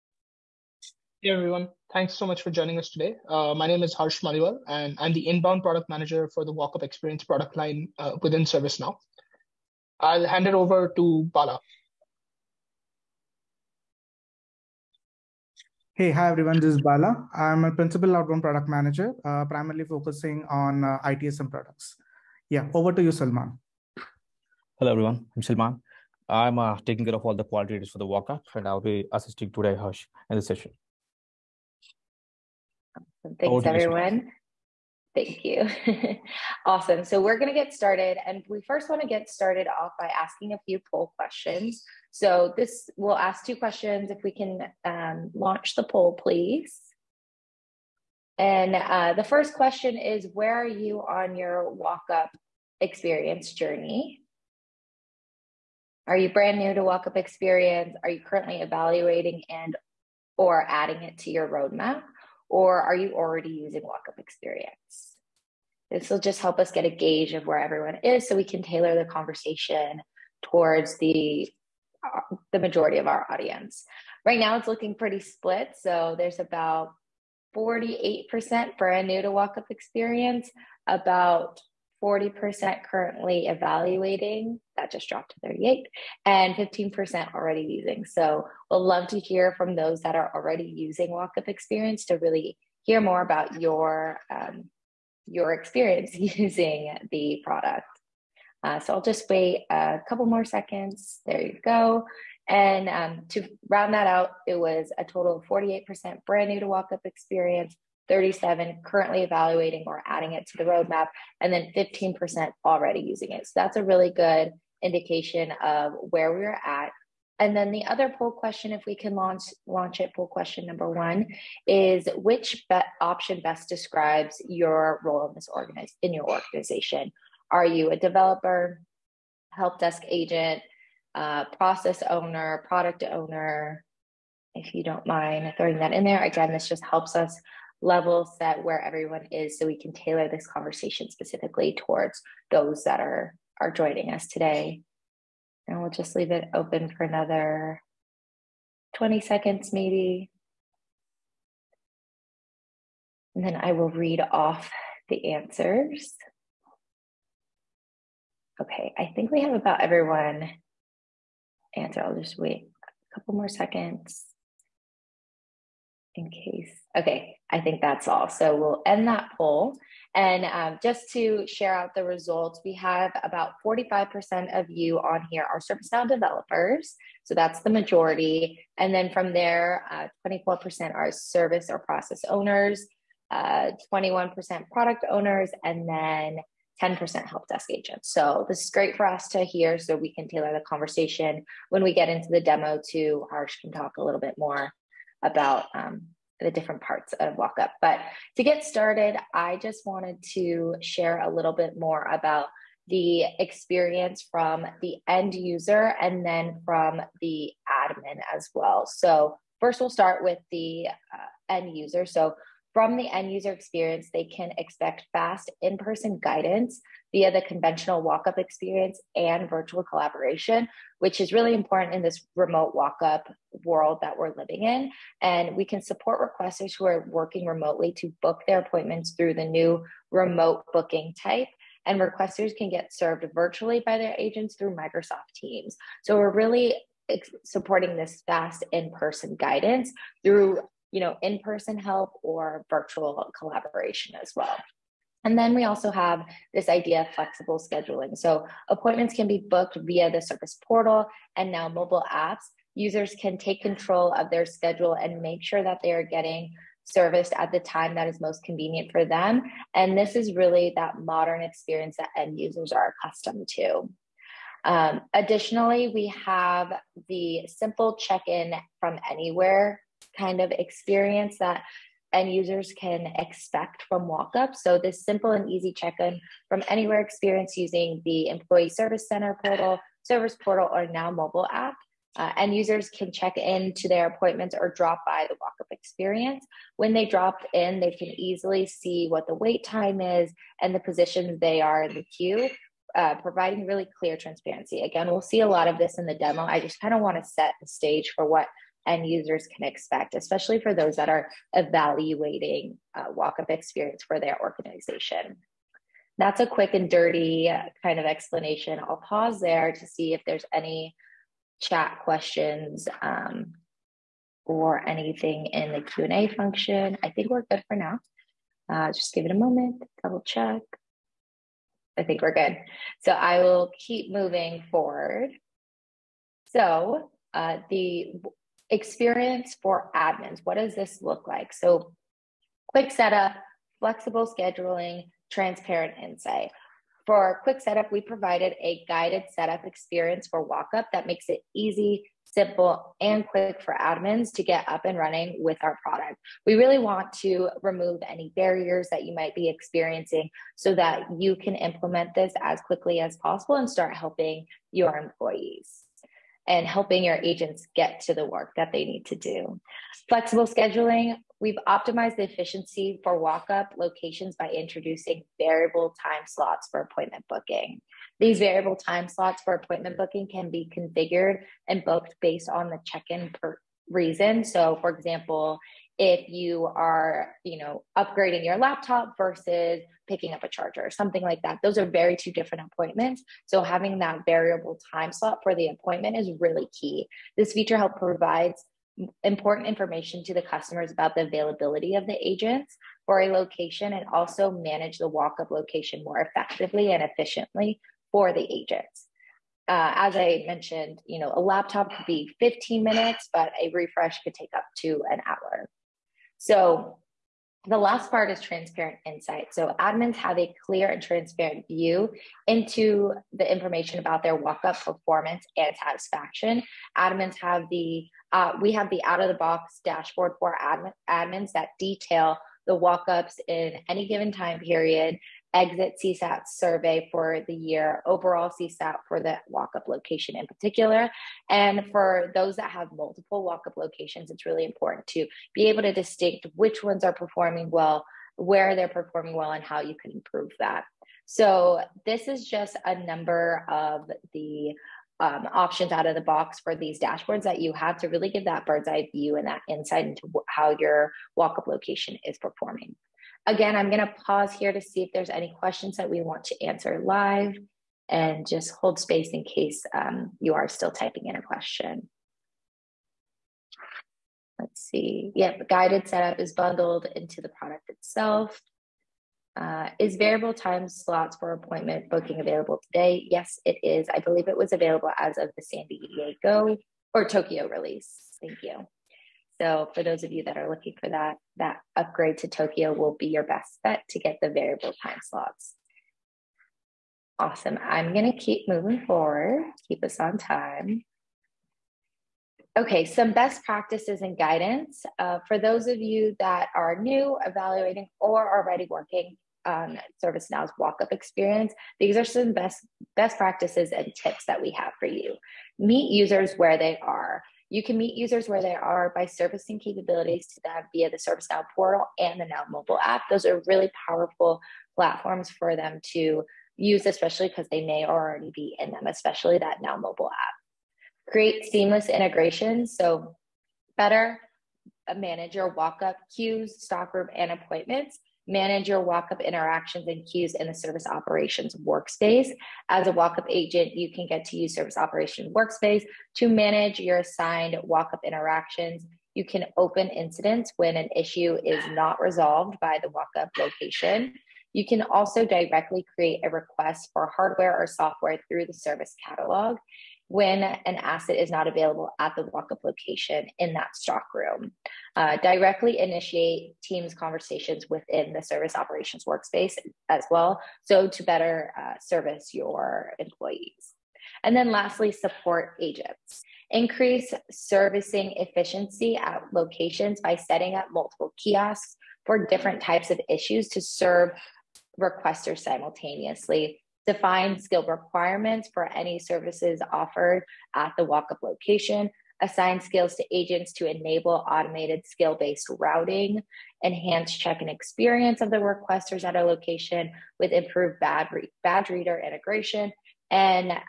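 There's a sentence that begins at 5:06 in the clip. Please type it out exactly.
That's a quick and dirty kind of explanation.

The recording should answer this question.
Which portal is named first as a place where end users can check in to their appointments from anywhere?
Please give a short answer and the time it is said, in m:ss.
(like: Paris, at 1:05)
Employee Service Center, at 4:38.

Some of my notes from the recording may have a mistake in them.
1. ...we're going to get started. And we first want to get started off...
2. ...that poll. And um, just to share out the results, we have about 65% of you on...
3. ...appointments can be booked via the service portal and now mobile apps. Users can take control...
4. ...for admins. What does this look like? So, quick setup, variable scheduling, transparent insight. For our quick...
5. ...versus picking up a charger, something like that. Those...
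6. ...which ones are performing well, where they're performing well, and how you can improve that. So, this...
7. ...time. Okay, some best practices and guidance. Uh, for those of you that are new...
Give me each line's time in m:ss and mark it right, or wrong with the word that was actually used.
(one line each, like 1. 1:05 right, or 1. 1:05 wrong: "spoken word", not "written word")
1. 0:37 right
2. 2:49 wrong: "45", not "65"
3. 4:08 right
4. 5:29 wrong: "flexible", not "variable"
5. 6:19 right
6. 7:16 right
7. 8:10 right.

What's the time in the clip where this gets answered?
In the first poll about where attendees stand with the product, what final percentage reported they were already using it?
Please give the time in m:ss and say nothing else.
1:51.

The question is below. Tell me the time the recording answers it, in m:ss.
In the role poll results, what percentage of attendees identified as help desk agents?
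3:06.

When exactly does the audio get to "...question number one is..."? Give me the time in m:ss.
2:00.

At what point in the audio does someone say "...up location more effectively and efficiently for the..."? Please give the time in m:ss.
6:35.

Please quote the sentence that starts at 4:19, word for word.
And this is really that modern experience that end users are accustomed to.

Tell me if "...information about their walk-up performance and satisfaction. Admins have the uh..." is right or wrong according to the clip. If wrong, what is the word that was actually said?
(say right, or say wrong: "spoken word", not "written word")
right.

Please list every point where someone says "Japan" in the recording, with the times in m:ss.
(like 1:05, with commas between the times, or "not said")
not said.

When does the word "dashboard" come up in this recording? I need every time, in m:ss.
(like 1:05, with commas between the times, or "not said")
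6:59, 7:26.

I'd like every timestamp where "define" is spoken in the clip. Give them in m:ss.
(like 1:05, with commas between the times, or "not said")
9:37.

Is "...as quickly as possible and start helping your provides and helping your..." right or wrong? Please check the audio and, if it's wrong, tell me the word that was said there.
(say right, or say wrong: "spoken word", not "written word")
wrong: "employees", not "provides".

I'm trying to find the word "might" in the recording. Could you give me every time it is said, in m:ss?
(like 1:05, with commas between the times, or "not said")
5:49.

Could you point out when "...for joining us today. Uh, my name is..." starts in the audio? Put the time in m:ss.
0:02.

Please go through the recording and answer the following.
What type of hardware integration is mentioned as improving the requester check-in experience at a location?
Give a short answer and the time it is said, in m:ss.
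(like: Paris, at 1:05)
Badge reader, at 9:51.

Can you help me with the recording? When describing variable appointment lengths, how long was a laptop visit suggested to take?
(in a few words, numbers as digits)
15 minutes.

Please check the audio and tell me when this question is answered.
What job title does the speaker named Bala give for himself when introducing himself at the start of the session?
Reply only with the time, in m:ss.
0:17.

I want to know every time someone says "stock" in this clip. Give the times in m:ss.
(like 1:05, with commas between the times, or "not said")
8:46, 9:13.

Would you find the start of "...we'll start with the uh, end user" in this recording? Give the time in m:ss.
3:29.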